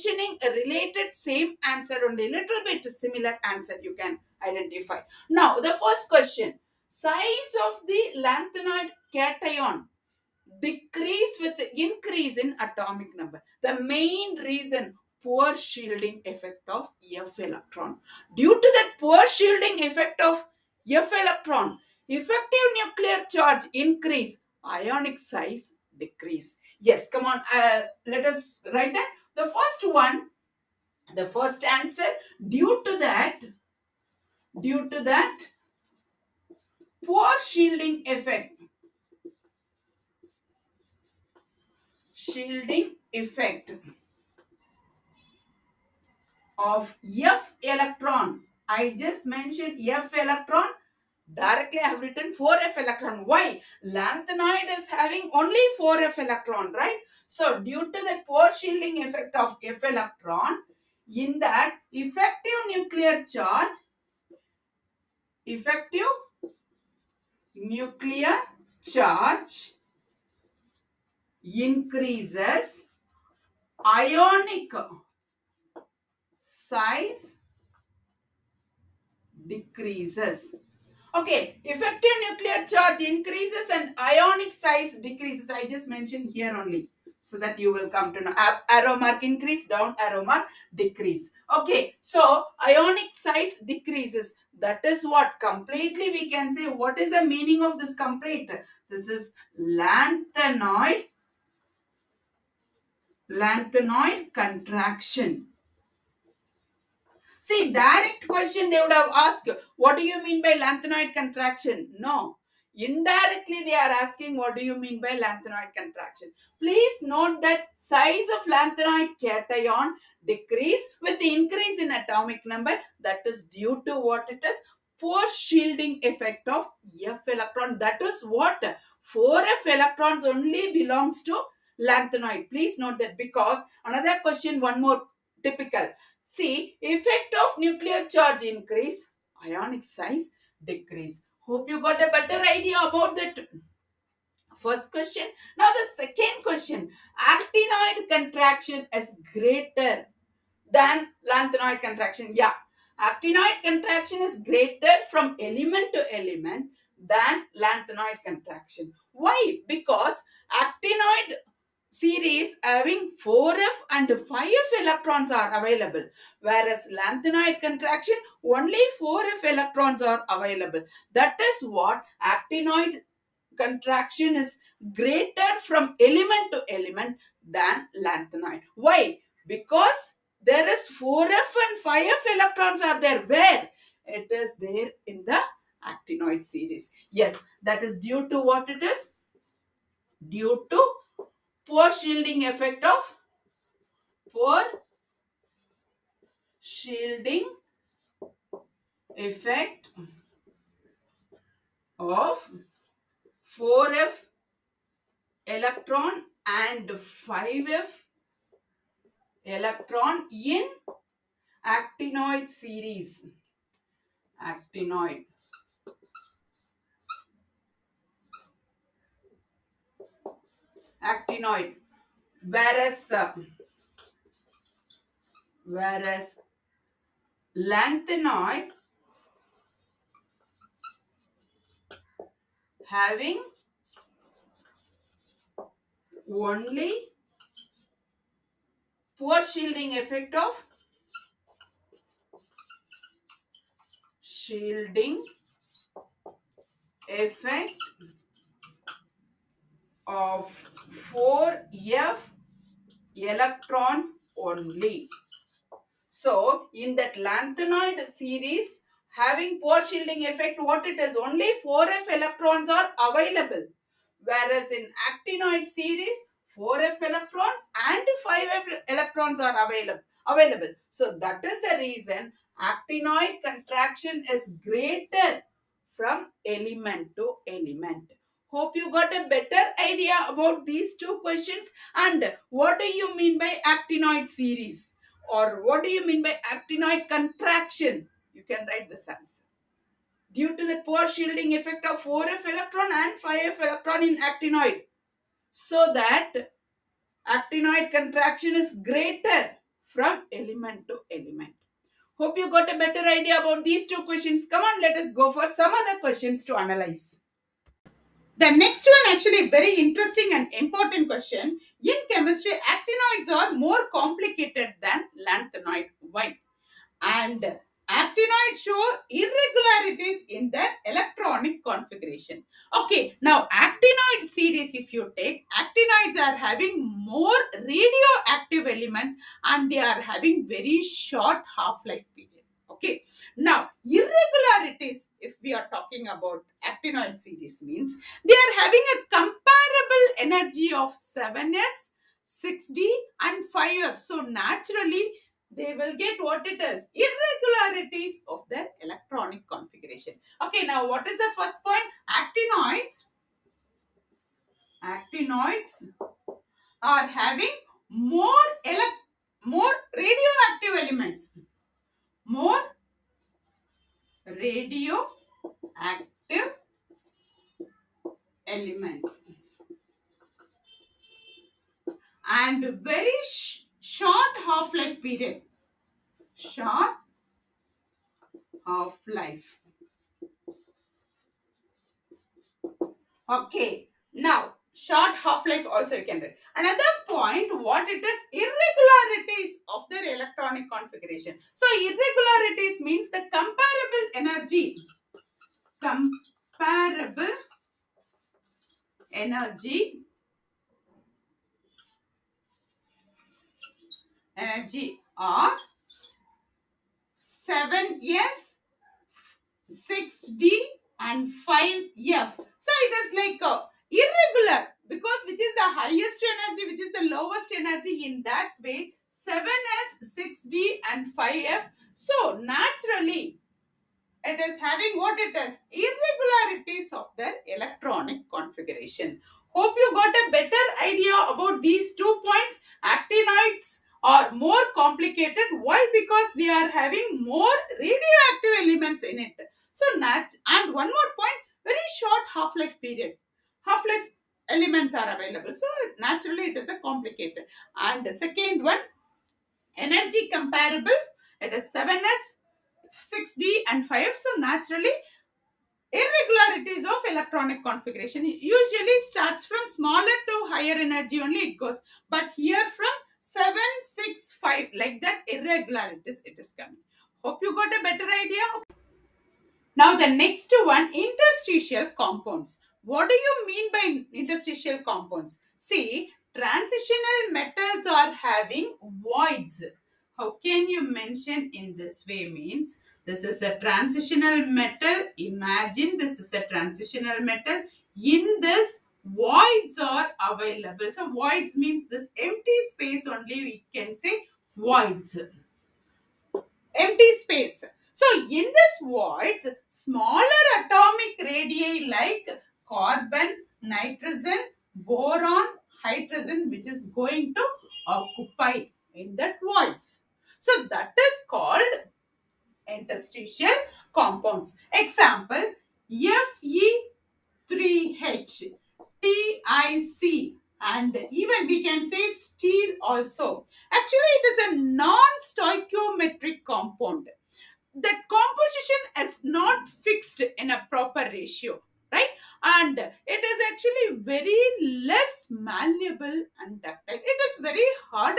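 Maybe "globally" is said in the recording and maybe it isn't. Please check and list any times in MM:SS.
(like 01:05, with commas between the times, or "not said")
not said.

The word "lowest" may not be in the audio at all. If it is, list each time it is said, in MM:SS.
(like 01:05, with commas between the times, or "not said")
06:57.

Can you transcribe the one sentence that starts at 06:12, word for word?
And very sh short half-life period.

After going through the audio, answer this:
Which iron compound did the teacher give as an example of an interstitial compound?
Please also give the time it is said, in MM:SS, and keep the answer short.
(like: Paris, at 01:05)
Fe3H, at 08:35.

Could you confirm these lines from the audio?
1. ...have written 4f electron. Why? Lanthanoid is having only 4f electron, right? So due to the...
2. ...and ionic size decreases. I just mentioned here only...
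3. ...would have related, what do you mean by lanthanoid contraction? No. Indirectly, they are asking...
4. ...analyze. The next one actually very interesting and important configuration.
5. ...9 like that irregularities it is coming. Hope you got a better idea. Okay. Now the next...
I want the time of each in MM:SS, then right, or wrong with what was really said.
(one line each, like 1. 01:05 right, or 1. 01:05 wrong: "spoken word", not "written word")
1. 00:51 right
2. 01:23 right
3. 01:48 wrong: "asked", not "related"
4. 05:06 wrong: "question", not "configuration"
5. 07:44 wrong: "5", not "9".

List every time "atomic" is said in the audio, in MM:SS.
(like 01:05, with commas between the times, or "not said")
00:12, 02:01, 08:20.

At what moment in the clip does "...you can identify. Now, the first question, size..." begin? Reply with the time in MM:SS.
00:03.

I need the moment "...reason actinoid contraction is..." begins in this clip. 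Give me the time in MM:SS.
04:31.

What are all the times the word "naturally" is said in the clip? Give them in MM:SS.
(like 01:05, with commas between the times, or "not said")
05:44, 07:02, 07:25, 07:34.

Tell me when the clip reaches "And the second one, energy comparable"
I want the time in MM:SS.
07:27.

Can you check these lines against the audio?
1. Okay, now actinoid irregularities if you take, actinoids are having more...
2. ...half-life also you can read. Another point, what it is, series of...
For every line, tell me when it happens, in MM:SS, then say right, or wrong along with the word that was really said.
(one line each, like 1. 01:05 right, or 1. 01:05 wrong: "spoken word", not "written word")
1. 05:22 wrong: "series", not "irregularities"
2. 06:25 wrong: "irregularities", not "series".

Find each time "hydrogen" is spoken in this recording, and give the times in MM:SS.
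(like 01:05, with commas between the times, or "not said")
08:25.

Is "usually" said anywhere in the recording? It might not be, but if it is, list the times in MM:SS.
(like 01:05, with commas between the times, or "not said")
07:38.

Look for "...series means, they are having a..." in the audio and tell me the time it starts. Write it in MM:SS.
05:37.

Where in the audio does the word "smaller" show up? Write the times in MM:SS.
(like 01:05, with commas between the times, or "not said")
07:39, 08:19.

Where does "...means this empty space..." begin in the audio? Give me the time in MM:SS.
08:11.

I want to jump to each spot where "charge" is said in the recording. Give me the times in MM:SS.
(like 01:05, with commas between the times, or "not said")
00:23, 01:03, 01:08, 01:22, 02:18.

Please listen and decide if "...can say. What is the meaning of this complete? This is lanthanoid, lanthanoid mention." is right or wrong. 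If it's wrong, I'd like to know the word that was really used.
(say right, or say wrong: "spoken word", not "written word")
wrong: "contraction", not "mention".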